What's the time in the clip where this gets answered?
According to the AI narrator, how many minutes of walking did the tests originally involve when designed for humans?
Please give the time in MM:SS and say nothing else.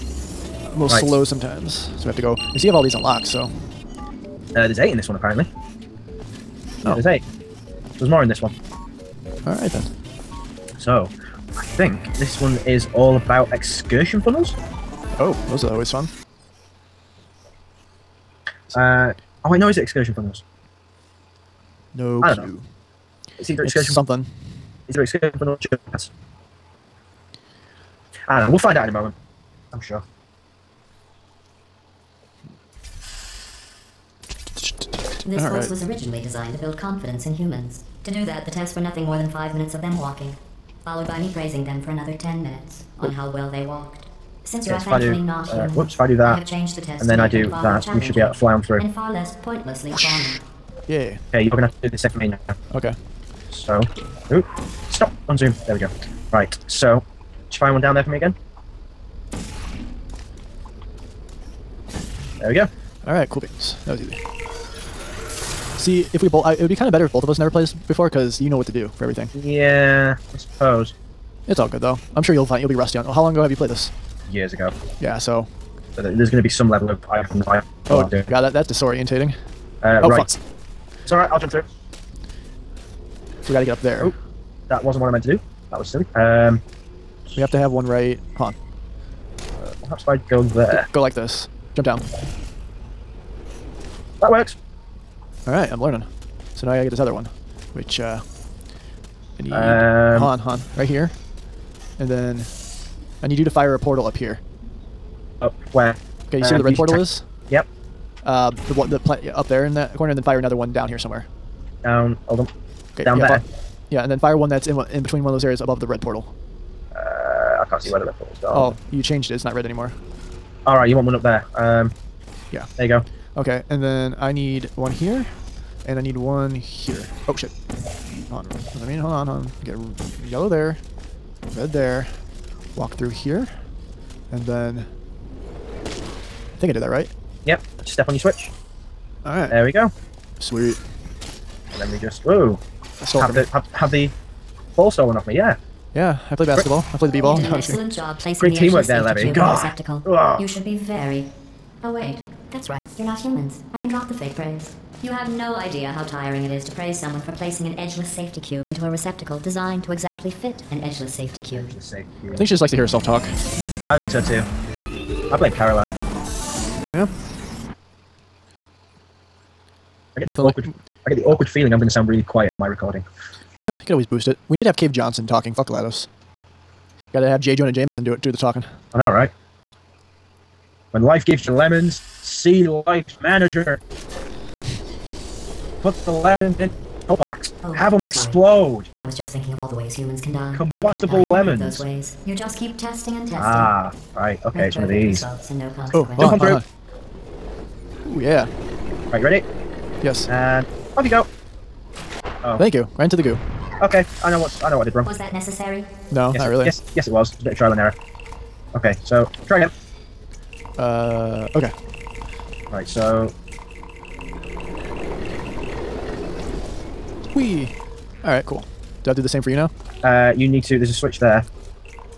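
00:39.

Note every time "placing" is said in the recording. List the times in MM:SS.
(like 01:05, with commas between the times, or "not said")
02:28, 02:37.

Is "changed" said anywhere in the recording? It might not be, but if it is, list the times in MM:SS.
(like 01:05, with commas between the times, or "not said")
00:46, 01:59.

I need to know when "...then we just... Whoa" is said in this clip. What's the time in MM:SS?
02:21.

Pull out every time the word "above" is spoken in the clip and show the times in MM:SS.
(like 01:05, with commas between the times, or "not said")
01:55.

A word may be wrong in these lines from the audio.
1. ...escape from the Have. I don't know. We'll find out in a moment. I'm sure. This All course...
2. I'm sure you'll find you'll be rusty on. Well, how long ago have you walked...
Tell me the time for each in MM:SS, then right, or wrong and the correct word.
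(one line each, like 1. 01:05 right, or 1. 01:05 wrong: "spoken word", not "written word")
1. 00:25 wrong: "Jets", not "Have"
2. 01:12 wrong: "played", not "walked".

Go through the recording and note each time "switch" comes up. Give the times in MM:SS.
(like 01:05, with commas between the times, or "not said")
02:18, 03:40.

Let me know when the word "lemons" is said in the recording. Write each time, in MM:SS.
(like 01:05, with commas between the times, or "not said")
03:01, 03:06, 03:11.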